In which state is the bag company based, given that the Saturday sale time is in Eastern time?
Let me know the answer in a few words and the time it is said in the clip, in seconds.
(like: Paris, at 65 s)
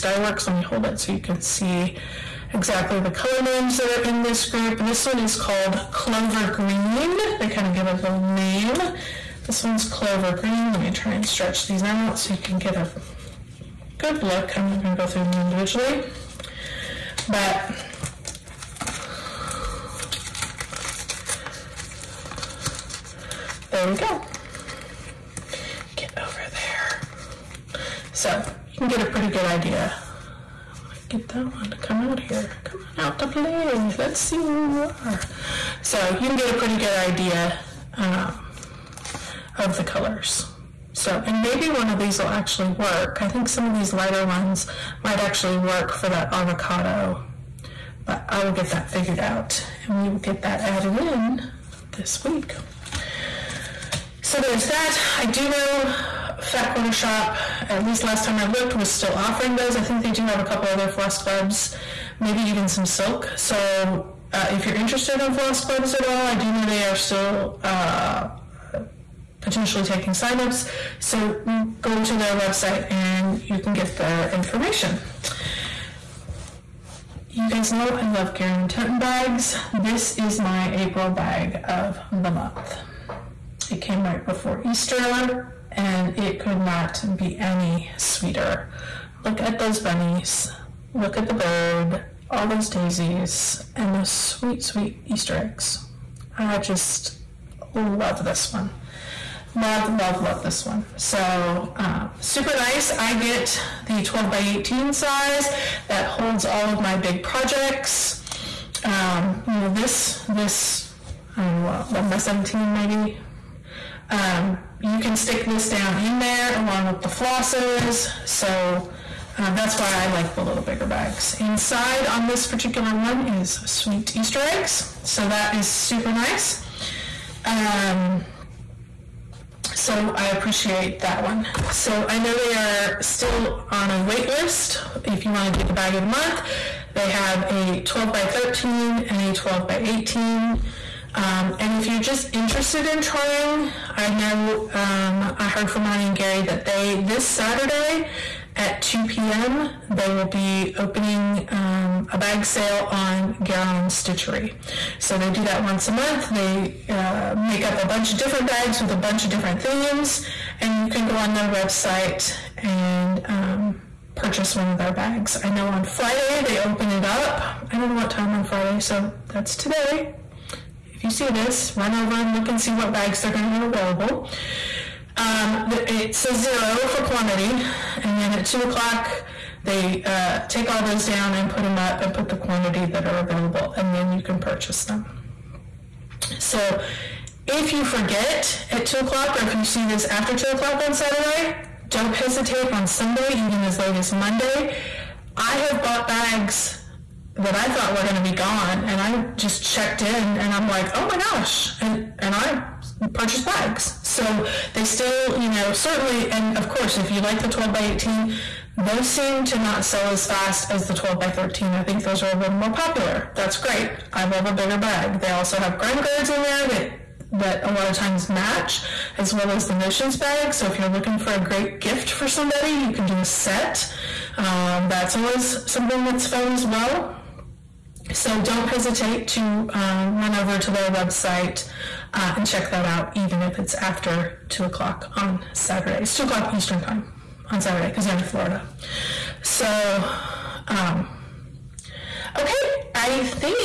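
Florida, at 238 s.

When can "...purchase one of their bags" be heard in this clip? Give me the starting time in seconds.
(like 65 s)
164 s.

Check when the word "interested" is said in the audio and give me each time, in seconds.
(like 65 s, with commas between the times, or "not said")
64 s, 142 s.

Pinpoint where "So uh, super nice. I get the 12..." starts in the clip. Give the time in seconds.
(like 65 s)
100 s.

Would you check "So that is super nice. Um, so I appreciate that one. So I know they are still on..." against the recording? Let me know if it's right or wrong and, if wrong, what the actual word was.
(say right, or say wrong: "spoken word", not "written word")
right.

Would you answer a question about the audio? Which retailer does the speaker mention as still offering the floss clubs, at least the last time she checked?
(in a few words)
Fat Quarter Shop.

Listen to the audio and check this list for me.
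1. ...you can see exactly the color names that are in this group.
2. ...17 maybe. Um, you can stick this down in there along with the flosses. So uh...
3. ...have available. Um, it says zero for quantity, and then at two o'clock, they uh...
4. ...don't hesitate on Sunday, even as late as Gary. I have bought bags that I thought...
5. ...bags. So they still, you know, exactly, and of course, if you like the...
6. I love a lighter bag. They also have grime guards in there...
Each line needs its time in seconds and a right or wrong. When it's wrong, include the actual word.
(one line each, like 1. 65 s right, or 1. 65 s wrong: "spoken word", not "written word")
1. 1 s right
2. 112 s right
3. 173 s right
4. 191 s wrong: "Monday", not "Gary"
5. 203 s wrong: "certainly", not "exactly"
6. 214 s wrong: "bigger", not "lighter".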